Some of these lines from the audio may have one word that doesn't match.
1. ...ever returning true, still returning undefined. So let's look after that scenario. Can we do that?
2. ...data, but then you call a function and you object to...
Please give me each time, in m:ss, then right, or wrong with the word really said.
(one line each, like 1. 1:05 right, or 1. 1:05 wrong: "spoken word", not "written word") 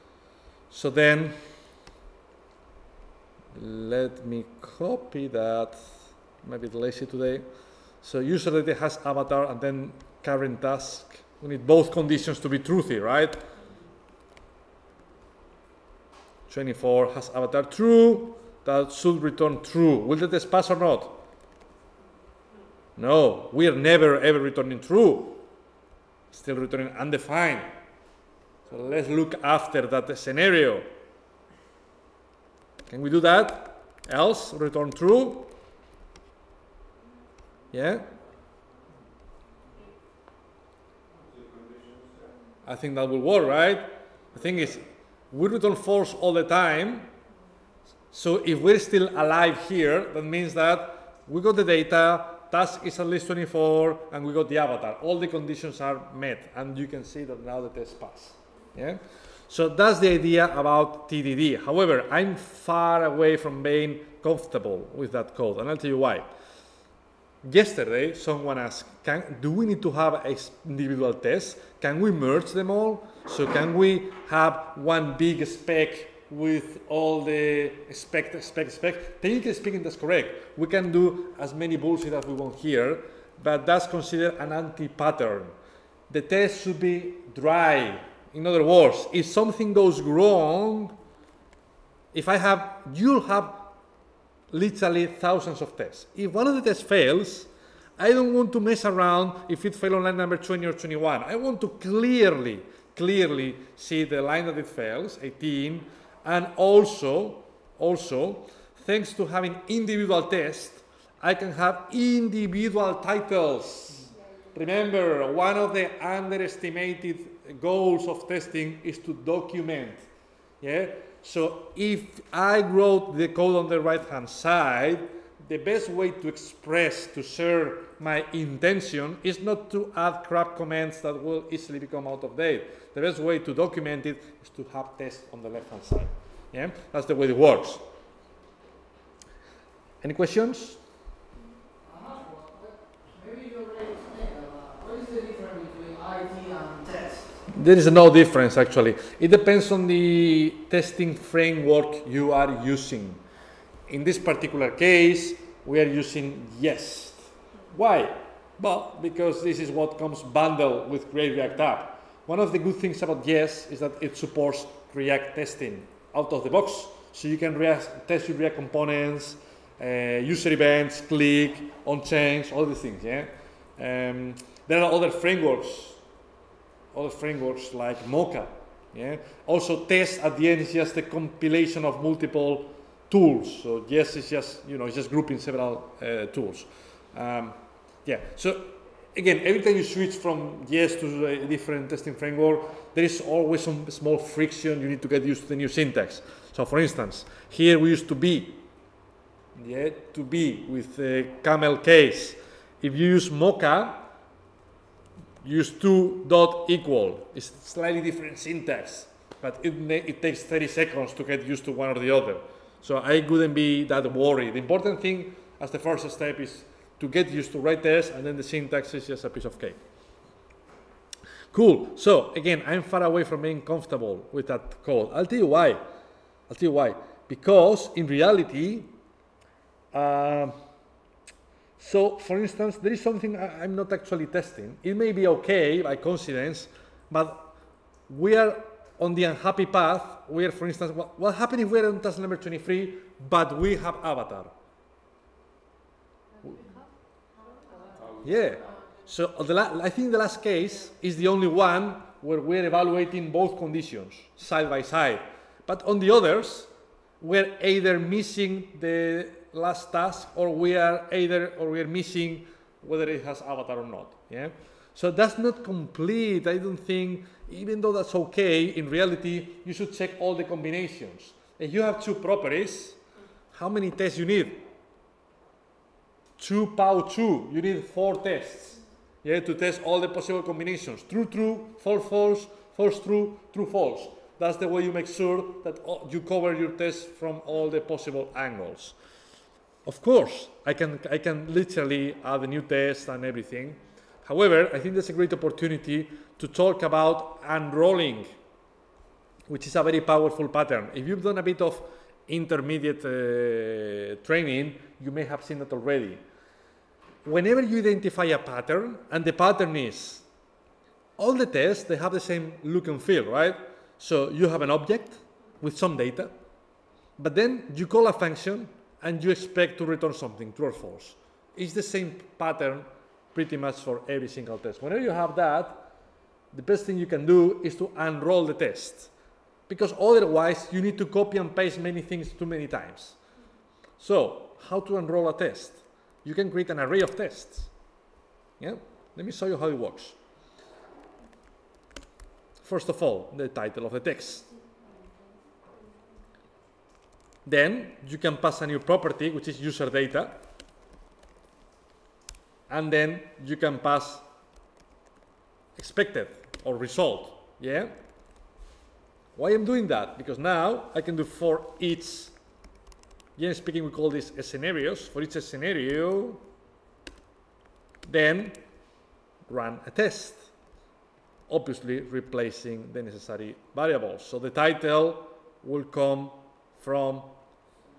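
1. 0:24 right
2. 5:15 wrong: "expect", not "object".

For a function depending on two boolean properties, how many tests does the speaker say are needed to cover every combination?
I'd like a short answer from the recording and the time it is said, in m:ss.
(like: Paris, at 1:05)
4, at 4:37.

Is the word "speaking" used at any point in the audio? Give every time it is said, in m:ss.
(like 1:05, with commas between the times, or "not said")
1:19, 6:03.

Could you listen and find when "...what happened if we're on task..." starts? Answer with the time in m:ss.
4:01.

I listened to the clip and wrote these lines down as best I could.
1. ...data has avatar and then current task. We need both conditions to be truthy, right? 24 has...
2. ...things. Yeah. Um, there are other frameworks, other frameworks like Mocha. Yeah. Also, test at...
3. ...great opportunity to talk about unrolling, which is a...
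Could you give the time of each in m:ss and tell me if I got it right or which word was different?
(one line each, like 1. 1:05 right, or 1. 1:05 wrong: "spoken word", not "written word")
1. 0:08 right
2. 2:52 right
3. 4:55 right.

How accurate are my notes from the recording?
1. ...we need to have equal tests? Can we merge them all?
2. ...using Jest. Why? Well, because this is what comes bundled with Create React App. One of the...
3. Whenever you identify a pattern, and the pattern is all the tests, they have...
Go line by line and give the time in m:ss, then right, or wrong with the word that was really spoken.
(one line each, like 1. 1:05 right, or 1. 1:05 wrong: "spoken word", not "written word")
1. 1:09 wrong: "individual", not "equal"
2. 2:35 right
3. 5:07 right.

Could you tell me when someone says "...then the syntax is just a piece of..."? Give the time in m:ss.
3:38.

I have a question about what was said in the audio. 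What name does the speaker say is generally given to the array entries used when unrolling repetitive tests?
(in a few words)
scenarios.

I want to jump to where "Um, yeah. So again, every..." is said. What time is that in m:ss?
3:07.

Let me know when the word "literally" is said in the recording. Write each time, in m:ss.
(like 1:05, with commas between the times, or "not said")
1:34, 4:51.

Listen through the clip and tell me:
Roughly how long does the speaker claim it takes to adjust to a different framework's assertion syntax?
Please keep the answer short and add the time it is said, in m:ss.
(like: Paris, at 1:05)
30 seconds, at 3:30.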